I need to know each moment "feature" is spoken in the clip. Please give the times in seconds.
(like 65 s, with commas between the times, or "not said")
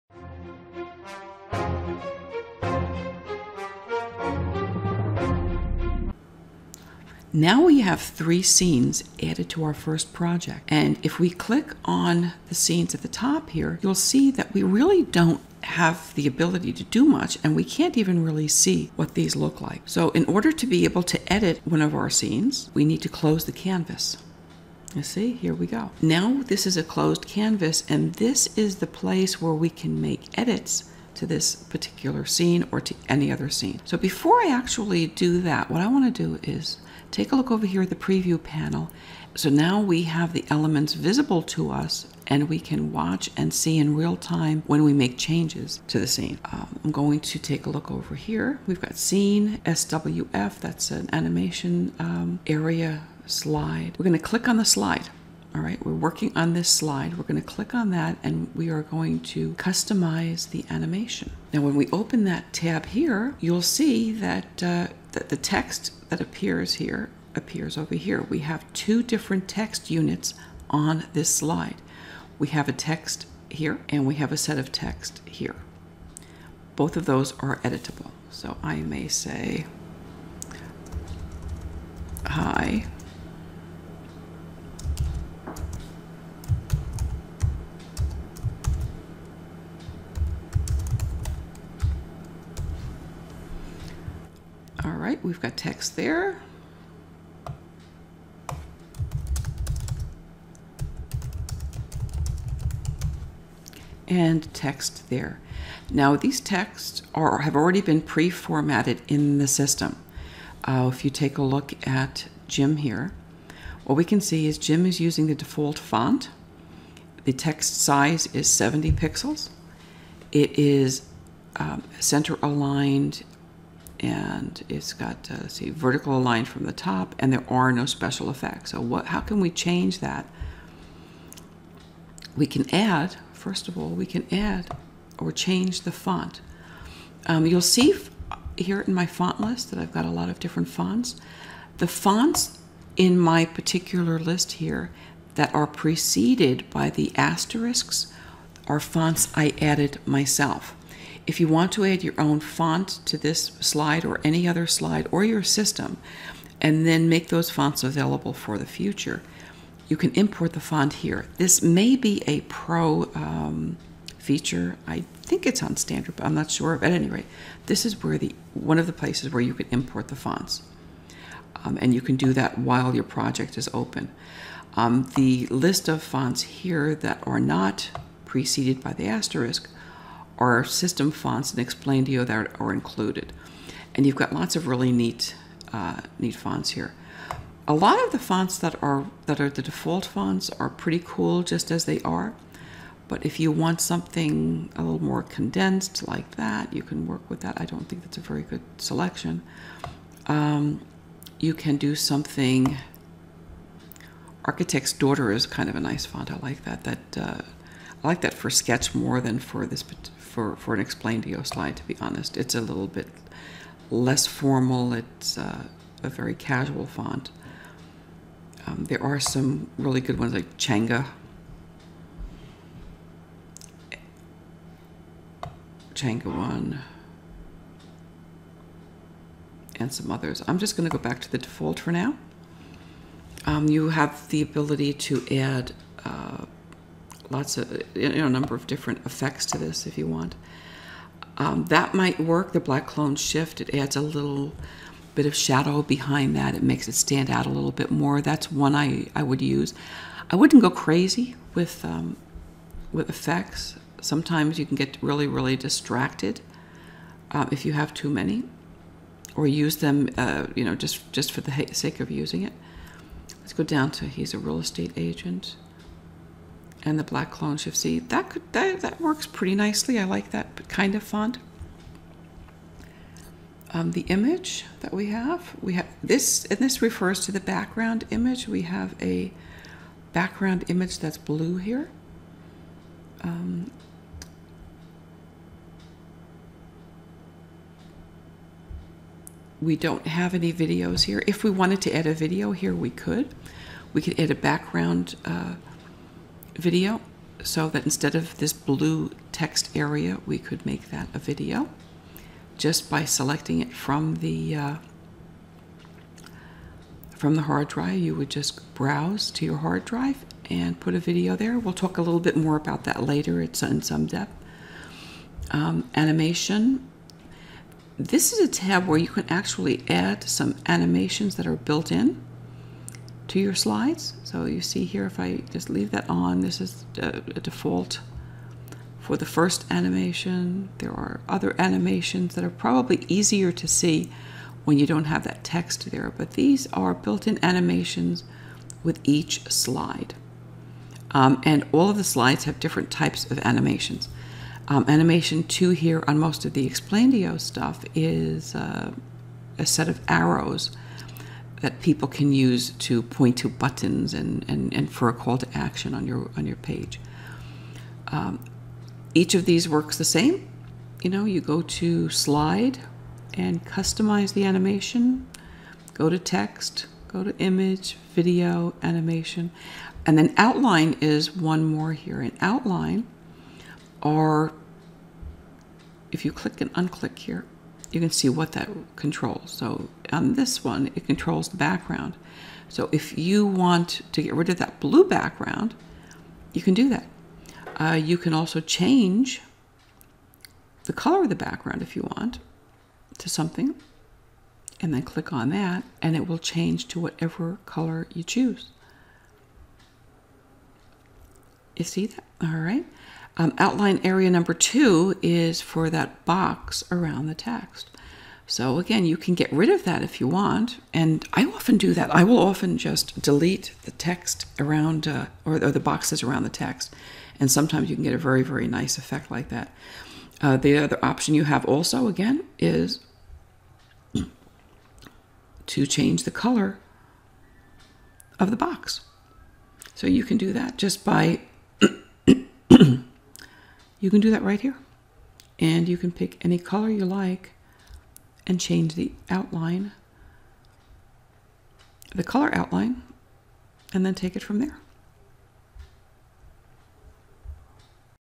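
164 s.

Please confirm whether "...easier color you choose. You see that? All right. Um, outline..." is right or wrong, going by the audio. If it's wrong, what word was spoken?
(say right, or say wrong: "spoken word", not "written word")
wrong: "whatever", not "easier".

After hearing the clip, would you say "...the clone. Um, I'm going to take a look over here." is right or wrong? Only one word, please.
wrong.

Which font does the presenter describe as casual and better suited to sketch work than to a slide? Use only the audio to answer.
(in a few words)
Architect's Daughter.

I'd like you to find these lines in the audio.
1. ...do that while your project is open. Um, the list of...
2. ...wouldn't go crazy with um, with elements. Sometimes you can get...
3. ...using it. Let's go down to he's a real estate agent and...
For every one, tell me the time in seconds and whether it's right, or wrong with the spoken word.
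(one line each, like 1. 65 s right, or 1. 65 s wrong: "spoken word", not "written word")
1. 172 s right
2. 250 s wrong: "effects", not "elements"
3. 262 s right.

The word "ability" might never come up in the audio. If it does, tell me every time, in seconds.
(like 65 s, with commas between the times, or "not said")
16 s, 234 s.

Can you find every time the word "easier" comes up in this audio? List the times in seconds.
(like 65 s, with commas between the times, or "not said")
333 s.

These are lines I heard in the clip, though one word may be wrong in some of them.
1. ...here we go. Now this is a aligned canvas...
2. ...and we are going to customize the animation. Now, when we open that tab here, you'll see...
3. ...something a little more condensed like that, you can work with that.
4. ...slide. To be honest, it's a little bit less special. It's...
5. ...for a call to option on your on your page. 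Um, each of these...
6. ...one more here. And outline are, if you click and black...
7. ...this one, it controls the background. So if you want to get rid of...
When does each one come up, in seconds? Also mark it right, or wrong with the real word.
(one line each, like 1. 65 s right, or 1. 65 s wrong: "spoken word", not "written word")
1. 25 s wrong: "closed", not "aligned"
2. 58 s right
3. 193 s right
4. 211 s wrong: "formal", not "special"
5. 354 s wrong: "action", not "option"
6. 371 s wrong: "unclick", not "black"
7. 380 s right.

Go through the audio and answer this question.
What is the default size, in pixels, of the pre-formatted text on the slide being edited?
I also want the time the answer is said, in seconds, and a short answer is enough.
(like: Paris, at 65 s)
70 pixels, at 118 s.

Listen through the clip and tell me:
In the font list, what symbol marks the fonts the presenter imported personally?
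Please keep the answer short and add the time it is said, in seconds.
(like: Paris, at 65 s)
Asterisks, at 147 s.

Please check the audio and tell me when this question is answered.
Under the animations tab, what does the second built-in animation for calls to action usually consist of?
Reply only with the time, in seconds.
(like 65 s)
350 s.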